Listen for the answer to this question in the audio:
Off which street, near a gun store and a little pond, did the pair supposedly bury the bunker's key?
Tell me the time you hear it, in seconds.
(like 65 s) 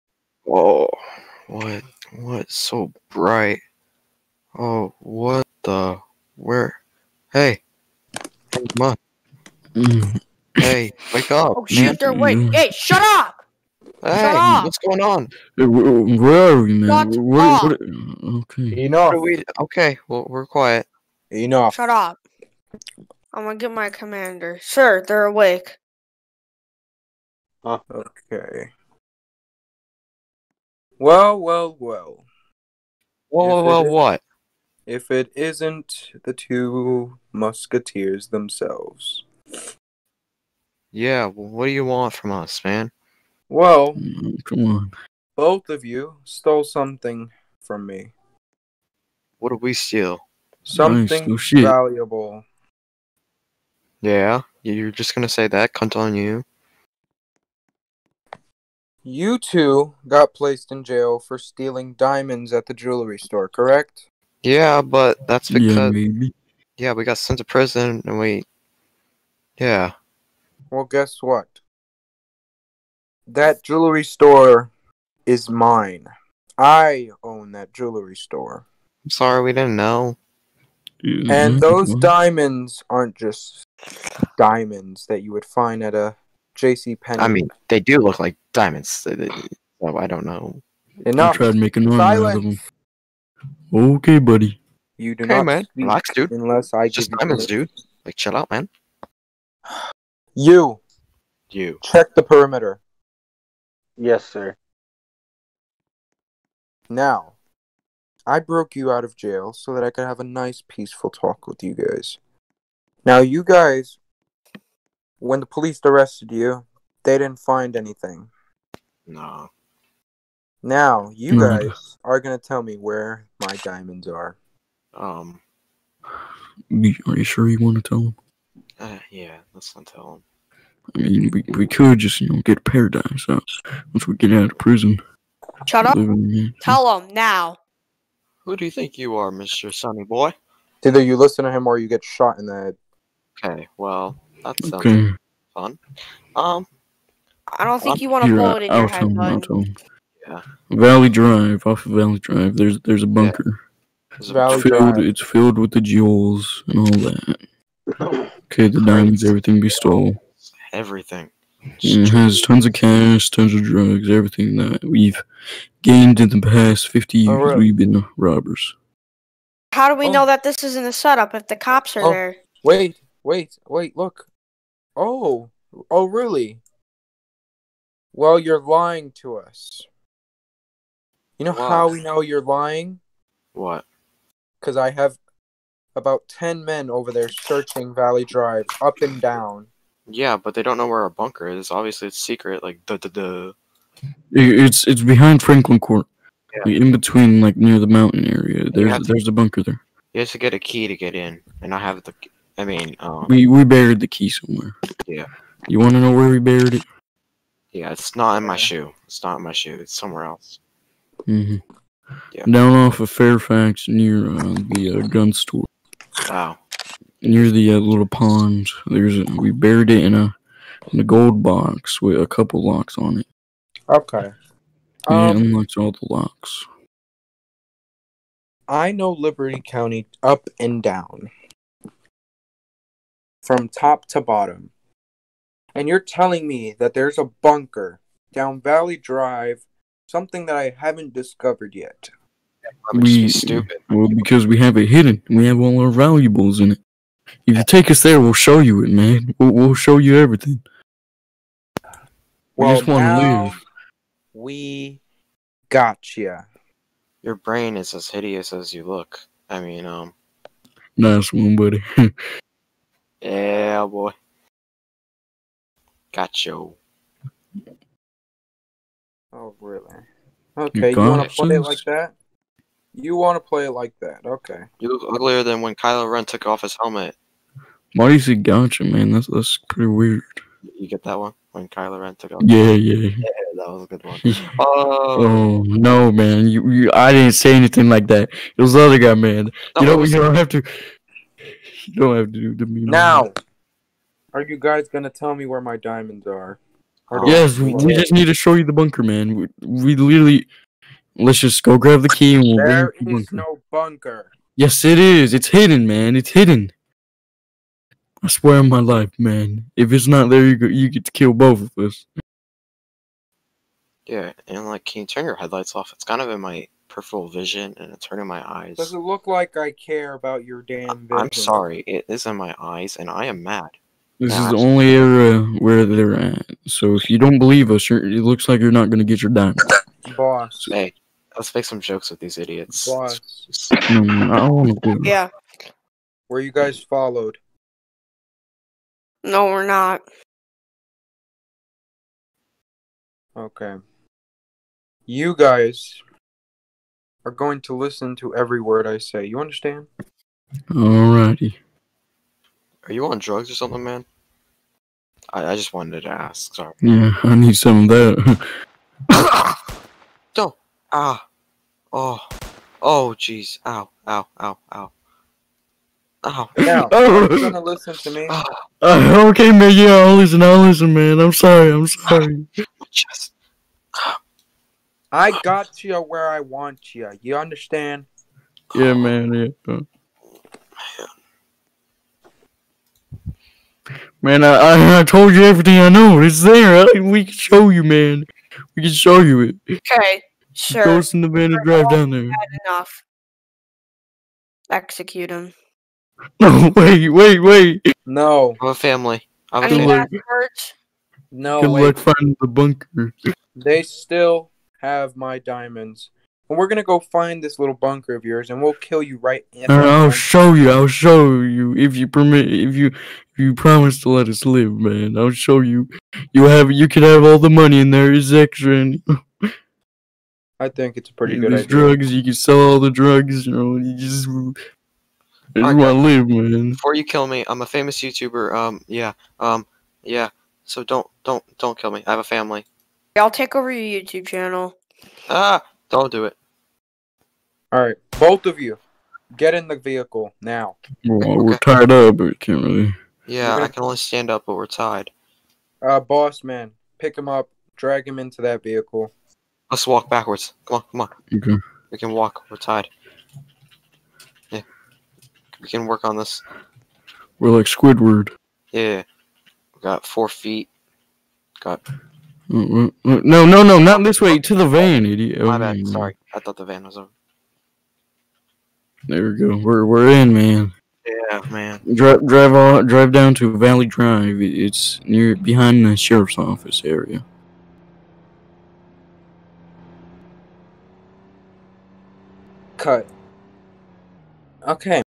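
213 s.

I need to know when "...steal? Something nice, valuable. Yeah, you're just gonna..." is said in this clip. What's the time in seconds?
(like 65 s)
49 s.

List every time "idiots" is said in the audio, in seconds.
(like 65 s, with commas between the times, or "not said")
332 s, 465 s.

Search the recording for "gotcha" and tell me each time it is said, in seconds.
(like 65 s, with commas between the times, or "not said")
255 s, 278 s.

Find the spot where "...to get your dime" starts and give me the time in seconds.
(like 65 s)
328 s.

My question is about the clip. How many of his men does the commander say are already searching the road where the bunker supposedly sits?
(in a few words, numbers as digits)
10.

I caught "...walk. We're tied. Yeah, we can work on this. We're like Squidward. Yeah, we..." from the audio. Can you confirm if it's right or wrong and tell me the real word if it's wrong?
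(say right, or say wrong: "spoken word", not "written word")
right.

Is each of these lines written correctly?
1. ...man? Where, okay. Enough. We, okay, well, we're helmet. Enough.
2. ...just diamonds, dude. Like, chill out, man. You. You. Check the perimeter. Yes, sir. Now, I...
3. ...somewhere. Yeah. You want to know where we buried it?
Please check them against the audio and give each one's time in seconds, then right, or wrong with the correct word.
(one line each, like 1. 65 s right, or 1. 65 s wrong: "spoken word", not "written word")
1. 16 s wrong: "quiet", not "helmet"
2. 96 s right
3. 204 s right.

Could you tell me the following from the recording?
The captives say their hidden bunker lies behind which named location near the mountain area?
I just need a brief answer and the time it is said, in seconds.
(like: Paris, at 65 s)
Franklin Court, at 195 s.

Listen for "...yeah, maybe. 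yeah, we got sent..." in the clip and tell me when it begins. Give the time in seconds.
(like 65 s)
65 s.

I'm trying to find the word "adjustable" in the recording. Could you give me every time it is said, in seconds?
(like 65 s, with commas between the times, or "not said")
not said.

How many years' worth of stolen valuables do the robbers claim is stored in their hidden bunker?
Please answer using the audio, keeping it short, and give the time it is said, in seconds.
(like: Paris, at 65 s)
50, at 166 s.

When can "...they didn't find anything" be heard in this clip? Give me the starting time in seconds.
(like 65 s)
117 s.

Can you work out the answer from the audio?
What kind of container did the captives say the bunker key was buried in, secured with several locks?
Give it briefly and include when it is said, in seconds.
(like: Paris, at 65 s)
Gold box, at 221 s.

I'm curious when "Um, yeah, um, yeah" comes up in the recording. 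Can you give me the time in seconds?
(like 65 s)
428 s.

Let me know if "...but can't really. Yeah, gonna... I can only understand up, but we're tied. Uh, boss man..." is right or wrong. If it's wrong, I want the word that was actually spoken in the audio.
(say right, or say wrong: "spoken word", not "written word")
wrong: "stand", not "understand".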